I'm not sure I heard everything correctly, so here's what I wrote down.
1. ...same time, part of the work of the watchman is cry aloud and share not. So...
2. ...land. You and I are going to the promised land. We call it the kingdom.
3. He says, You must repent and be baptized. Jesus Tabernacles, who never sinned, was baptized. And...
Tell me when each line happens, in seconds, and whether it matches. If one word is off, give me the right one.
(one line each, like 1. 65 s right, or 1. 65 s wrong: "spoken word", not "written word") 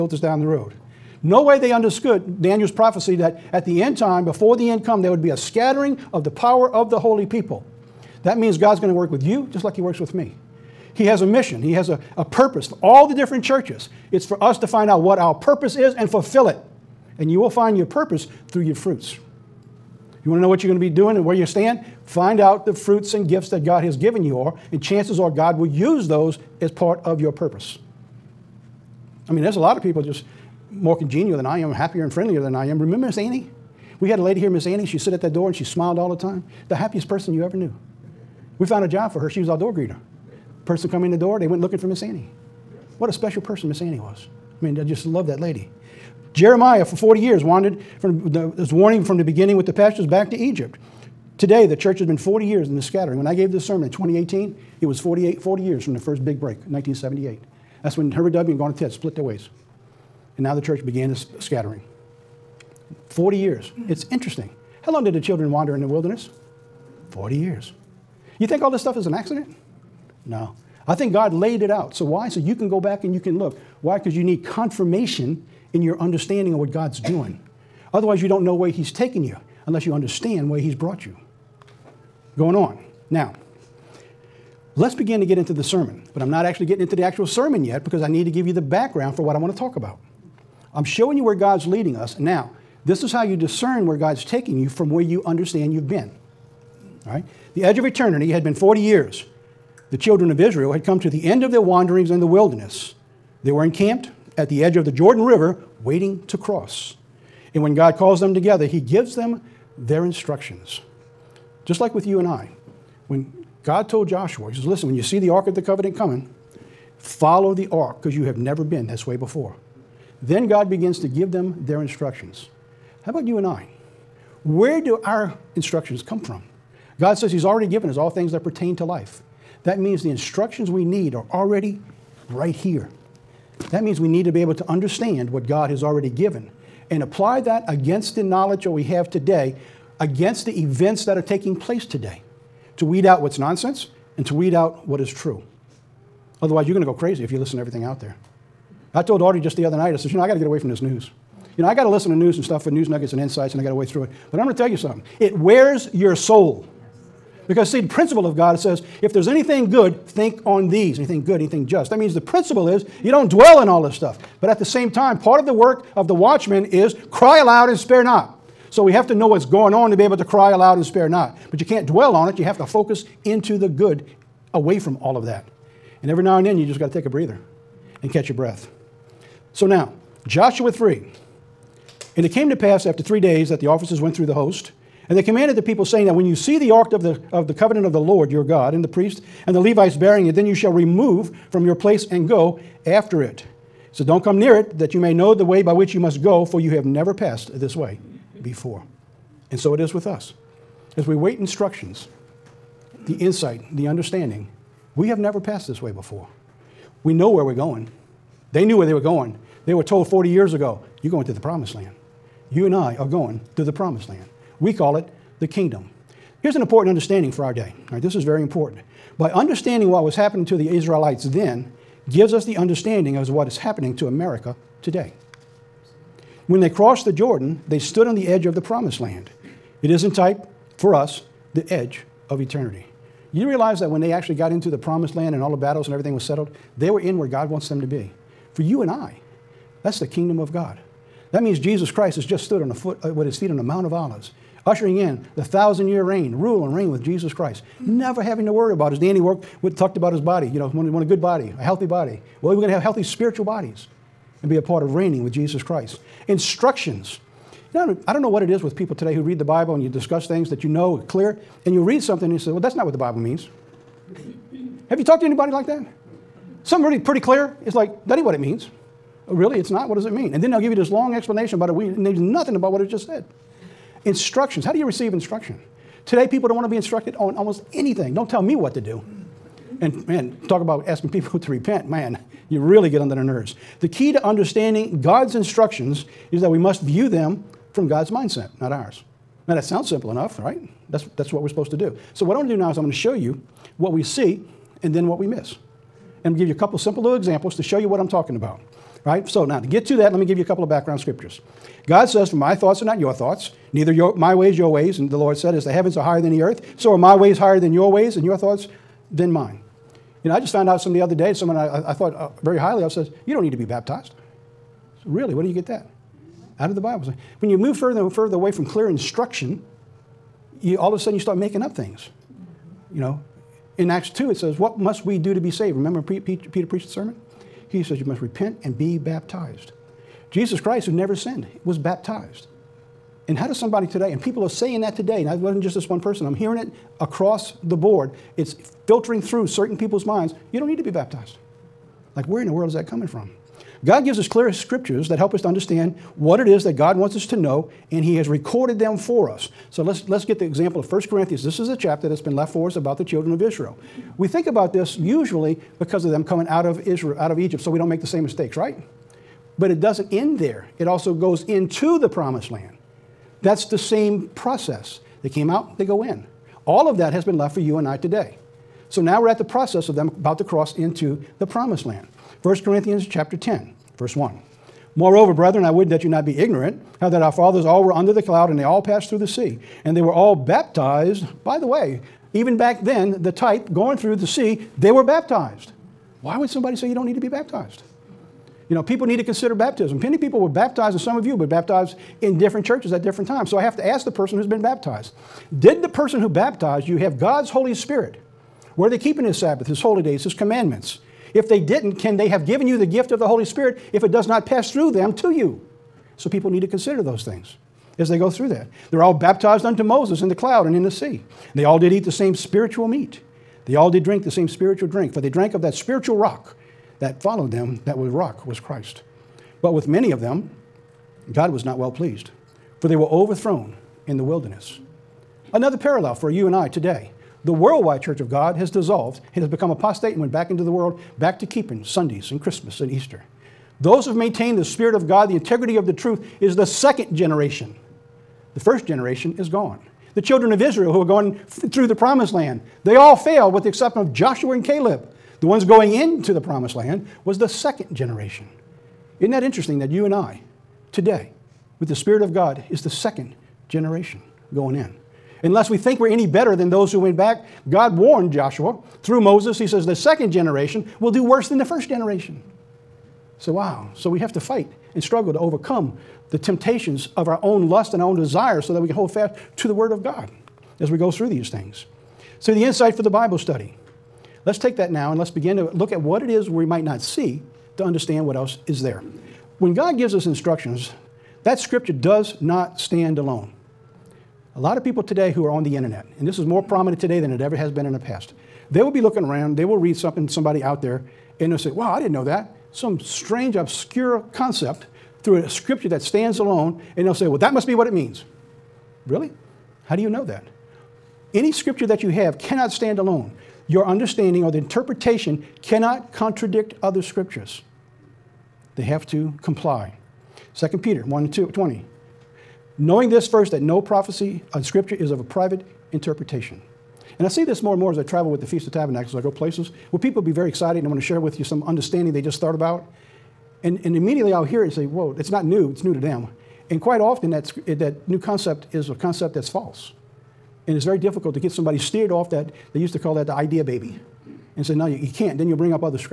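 1. 164 s wrong: "spare", not "share"
2. 211 s right
3. 327 s wrong: "Christ", not "Tabernacles".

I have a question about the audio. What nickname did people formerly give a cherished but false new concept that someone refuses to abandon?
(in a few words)
the idea baby.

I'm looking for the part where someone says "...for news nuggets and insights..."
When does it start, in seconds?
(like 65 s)
152 s.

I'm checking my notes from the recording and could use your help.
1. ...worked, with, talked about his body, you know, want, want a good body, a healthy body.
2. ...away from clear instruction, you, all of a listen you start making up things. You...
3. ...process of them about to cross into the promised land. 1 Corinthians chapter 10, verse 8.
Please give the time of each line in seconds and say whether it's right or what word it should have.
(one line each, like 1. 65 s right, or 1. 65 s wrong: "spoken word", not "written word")
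1. 249 s right
2. 318 s wrong: "sudden", not "listen"
3. 369 s wrong: "1", not "8".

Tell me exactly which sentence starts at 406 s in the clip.
So people need to consider those things as they go through that.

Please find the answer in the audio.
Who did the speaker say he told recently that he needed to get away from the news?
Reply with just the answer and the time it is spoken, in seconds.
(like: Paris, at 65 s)
Audrey, at 149 s.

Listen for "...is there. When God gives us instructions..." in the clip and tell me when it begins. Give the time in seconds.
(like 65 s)
478 s.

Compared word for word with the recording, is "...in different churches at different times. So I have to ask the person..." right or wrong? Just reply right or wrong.
right.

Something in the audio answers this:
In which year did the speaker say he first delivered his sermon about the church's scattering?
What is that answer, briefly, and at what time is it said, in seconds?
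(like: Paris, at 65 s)
2018, at 53 s.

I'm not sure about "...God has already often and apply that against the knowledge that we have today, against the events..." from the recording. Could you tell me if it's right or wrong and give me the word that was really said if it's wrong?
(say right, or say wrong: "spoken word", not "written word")
wrong: "given", not "often".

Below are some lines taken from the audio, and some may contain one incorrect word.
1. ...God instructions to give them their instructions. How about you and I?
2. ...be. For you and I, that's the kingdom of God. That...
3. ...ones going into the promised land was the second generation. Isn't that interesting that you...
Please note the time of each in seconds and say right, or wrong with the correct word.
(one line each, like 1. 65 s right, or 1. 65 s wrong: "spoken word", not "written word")
1. 120 s wrong: "begins", not "instructions"
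2. 237 s right
3. 445 s right.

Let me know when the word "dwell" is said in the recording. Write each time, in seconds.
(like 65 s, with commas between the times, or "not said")
163 s, 171 s.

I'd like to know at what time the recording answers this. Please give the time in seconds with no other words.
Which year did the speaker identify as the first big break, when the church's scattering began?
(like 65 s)
56 s.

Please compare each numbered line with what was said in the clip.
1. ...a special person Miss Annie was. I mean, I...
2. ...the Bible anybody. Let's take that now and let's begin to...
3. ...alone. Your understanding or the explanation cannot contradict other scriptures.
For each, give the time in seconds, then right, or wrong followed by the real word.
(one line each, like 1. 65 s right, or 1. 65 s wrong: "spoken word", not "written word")
1. 43 s right
2. 473 s wrong: "study", not "anybody"
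3. 502 s wrong: "interpretation", not "explanation".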